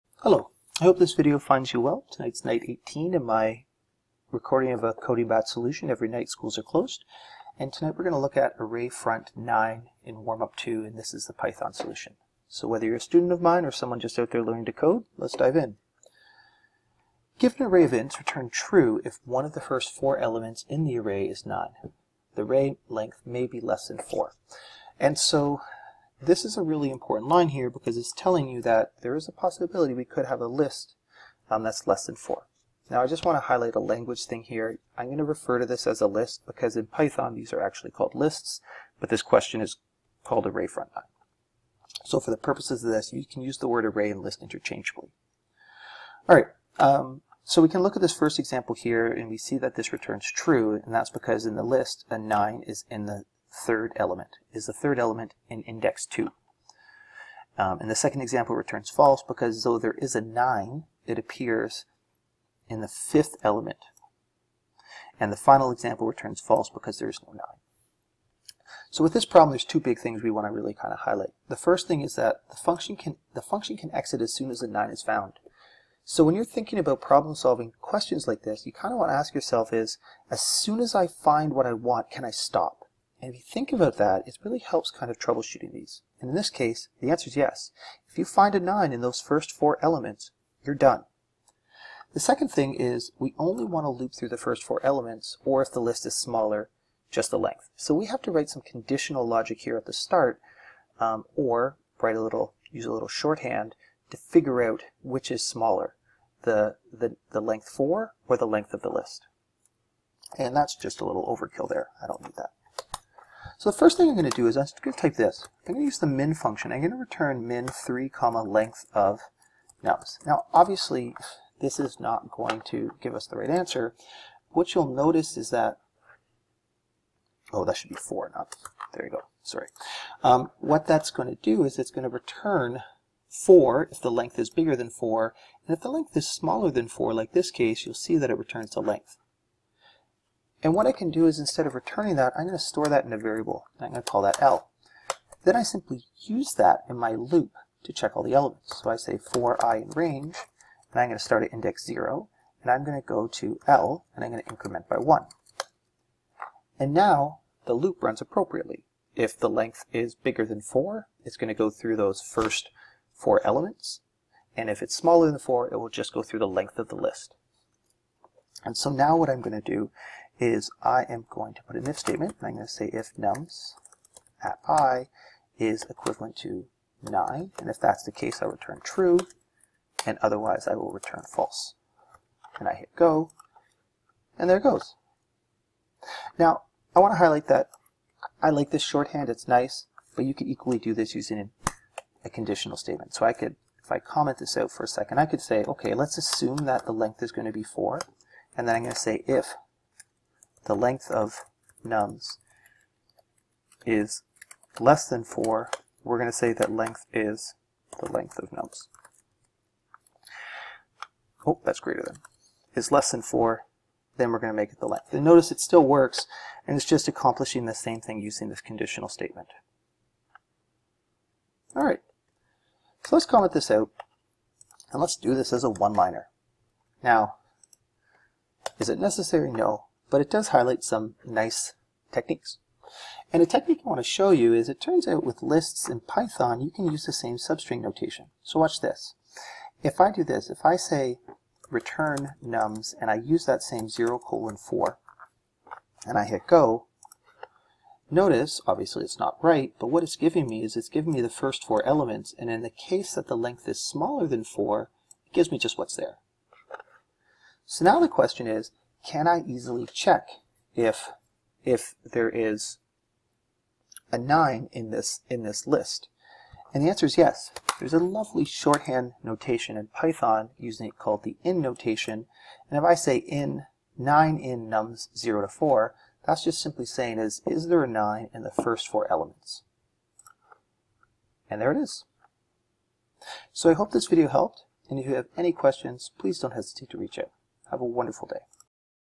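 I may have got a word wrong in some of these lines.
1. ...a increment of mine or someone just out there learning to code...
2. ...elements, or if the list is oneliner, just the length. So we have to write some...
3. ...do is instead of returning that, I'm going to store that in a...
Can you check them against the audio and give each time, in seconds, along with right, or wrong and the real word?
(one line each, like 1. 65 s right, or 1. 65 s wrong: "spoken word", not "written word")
1. 12 s wrong: "student", not "increment"
2. 94 s wrong: "smaller", not "oneliner"
3. 141 s right.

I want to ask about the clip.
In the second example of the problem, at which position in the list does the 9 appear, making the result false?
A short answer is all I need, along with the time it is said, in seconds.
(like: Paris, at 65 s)
fifth element, at 62 s.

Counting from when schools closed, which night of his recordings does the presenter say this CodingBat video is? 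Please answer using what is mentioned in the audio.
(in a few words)
18.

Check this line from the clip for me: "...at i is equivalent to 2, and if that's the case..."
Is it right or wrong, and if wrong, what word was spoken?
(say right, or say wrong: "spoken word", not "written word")
wrong: "9", not "2".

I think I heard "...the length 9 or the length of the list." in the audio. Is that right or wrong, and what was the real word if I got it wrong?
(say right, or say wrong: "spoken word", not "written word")
wrong: "4", not "9".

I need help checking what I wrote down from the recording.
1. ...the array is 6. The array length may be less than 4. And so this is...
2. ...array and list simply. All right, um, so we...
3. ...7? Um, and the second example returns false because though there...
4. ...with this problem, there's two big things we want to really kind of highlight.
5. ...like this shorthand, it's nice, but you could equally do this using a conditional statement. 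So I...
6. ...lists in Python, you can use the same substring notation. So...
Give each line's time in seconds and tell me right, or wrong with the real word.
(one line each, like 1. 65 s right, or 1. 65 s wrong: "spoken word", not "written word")
1. 20 s wrong: "9", not "6"
2. 43 s wrong: "interchangeably", not "simply"
3. 56 s wrong: "2", not "7"
4. 69 s right
5. 188 s right
6. 235 s right.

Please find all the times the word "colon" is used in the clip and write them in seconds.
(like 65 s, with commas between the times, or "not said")
244 s.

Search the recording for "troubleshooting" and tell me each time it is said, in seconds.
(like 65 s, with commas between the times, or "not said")
85 s.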